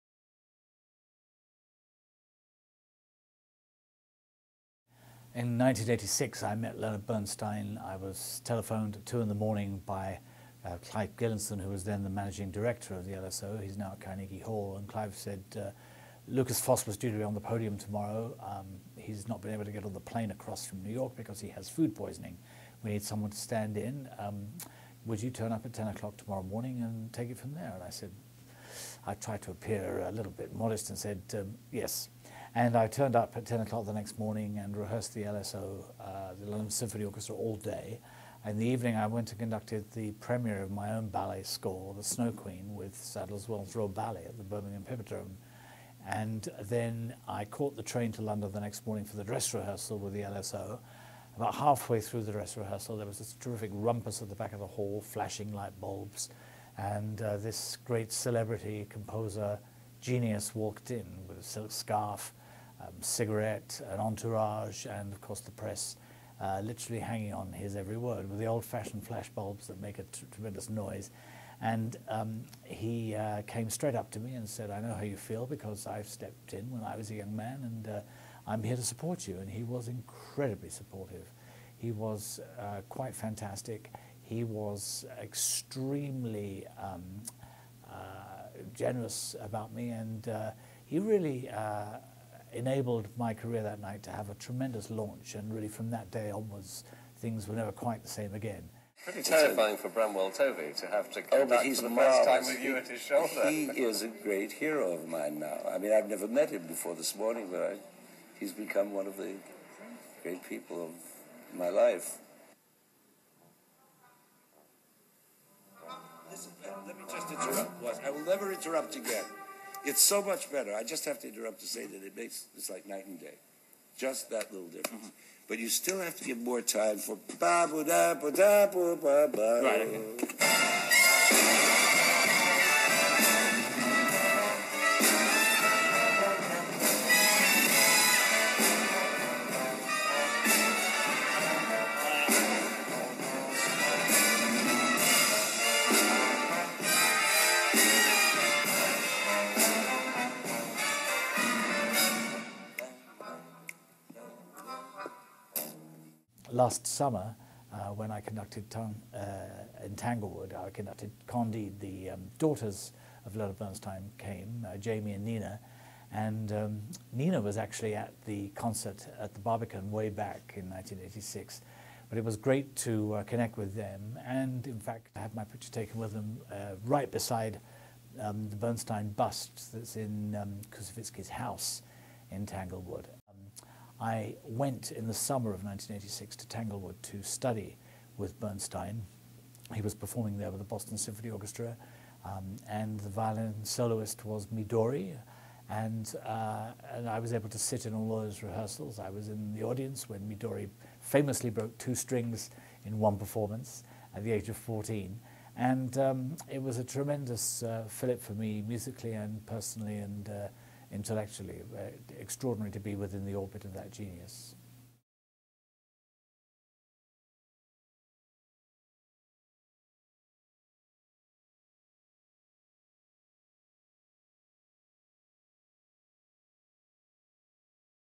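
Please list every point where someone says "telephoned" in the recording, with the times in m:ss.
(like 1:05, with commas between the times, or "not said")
0:08.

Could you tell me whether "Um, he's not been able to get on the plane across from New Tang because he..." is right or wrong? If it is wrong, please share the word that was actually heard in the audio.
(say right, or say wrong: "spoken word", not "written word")
wrong: "York", not "Tang".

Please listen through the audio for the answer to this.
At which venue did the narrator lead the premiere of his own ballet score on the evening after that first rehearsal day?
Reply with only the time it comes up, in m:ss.
0:44.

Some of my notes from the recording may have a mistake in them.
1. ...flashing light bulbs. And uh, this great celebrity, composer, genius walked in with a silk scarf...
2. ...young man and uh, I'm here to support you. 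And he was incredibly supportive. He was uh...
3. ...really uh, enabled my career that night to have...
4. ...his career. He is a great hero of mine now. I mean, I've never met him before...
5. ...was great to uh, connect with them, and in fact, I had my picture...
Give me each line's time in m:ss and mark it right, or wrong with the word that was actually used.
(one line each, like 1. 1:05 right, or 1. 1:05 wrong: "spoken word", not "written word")
1. 0:55 right
2. 1:17 right
3. 1:30 right
4. 1:42 wrong: "shoulder", not "career"
5. 2:52 right.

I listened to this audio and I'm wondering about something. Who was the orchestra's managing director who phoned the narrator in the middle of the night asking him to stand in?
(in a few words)
Clive Gillinson.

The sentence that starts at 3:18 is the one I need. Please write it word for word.
I was in the audience when Midori famously broke two strings in one performance at the age of 14.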